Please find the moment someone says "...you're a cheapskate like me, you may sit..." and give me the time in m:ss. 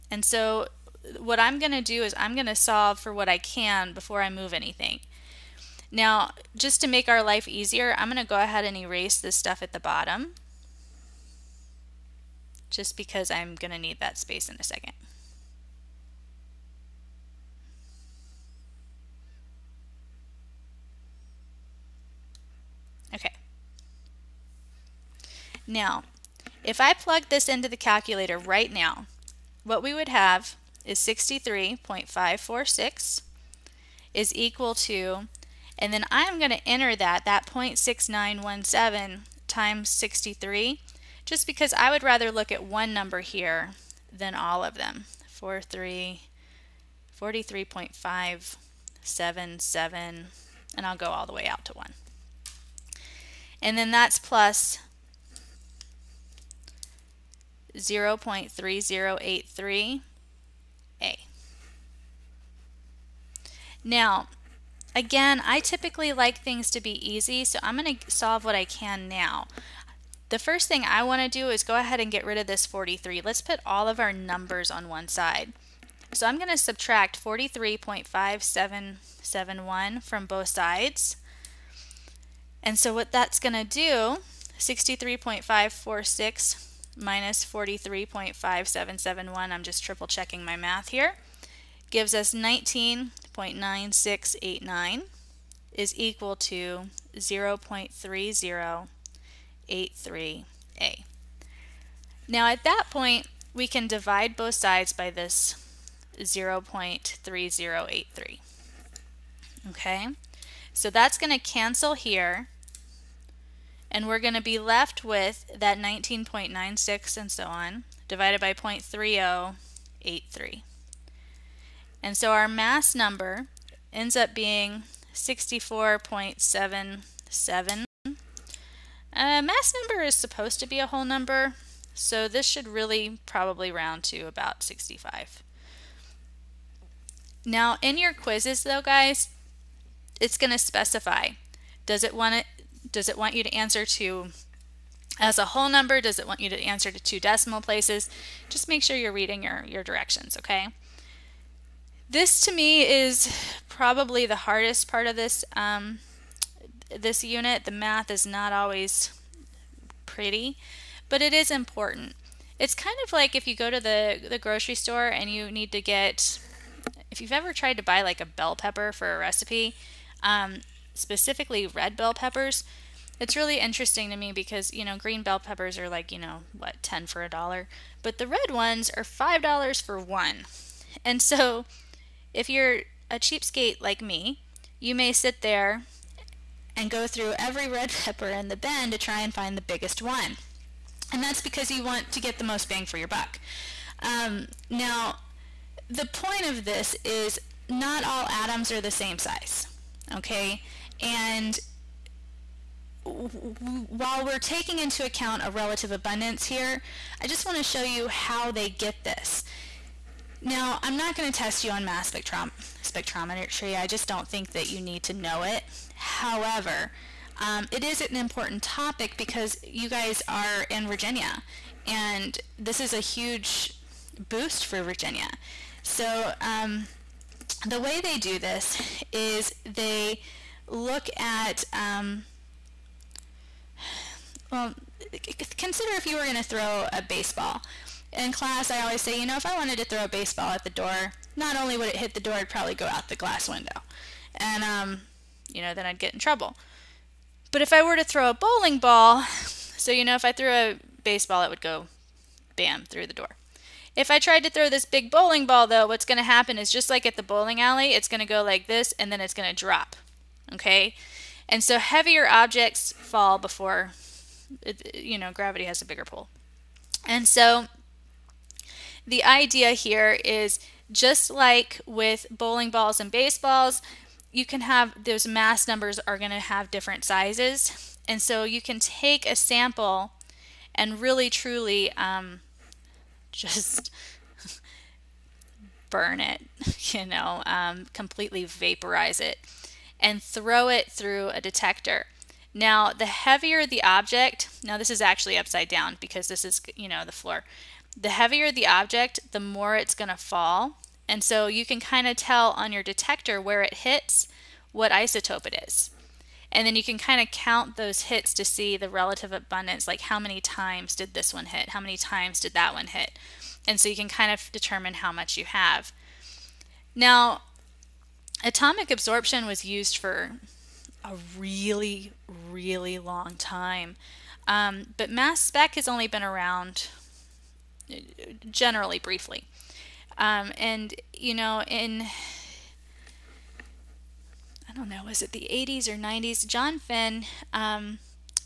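3:02.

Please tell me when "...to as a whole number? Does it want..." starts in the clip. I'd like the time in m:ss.
2:23.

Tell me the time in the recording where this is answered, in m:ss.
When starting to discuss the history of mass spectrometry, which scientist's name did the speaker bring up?
5:36.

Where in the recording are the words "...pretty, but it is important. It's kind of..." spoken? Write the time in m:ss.
2:40.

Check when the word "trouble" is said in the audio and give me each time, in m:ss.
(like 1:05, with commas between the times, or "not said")
4:06.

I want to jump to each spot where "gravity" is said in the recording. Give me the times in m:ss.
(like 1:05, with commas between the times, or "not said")
4:25.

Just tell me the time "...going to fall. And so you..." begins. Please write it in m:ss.
4:59.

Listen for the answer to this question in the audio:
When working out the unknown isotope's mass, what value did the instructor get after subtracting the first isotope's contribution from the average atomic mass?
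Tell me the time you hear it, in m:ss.
1:32.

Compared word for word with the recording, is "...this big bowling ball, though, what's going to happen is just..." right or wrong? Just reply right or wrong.
right.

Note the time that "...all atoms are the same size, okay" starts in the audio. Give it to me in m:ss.
3:18.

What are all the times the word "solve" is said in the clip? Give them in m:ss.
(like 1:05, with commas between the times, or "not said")
0:02, 1:08.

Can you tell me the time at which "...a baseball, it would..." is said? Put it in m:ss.
4:10.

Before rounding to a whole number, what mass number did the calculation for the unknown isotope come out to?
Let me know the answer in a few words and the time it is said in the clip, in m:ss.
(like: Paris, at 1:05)
64.77, at 2:05.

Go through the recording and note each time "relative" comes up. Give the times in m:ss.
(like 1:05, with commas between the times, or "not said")
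3:25, 5:08.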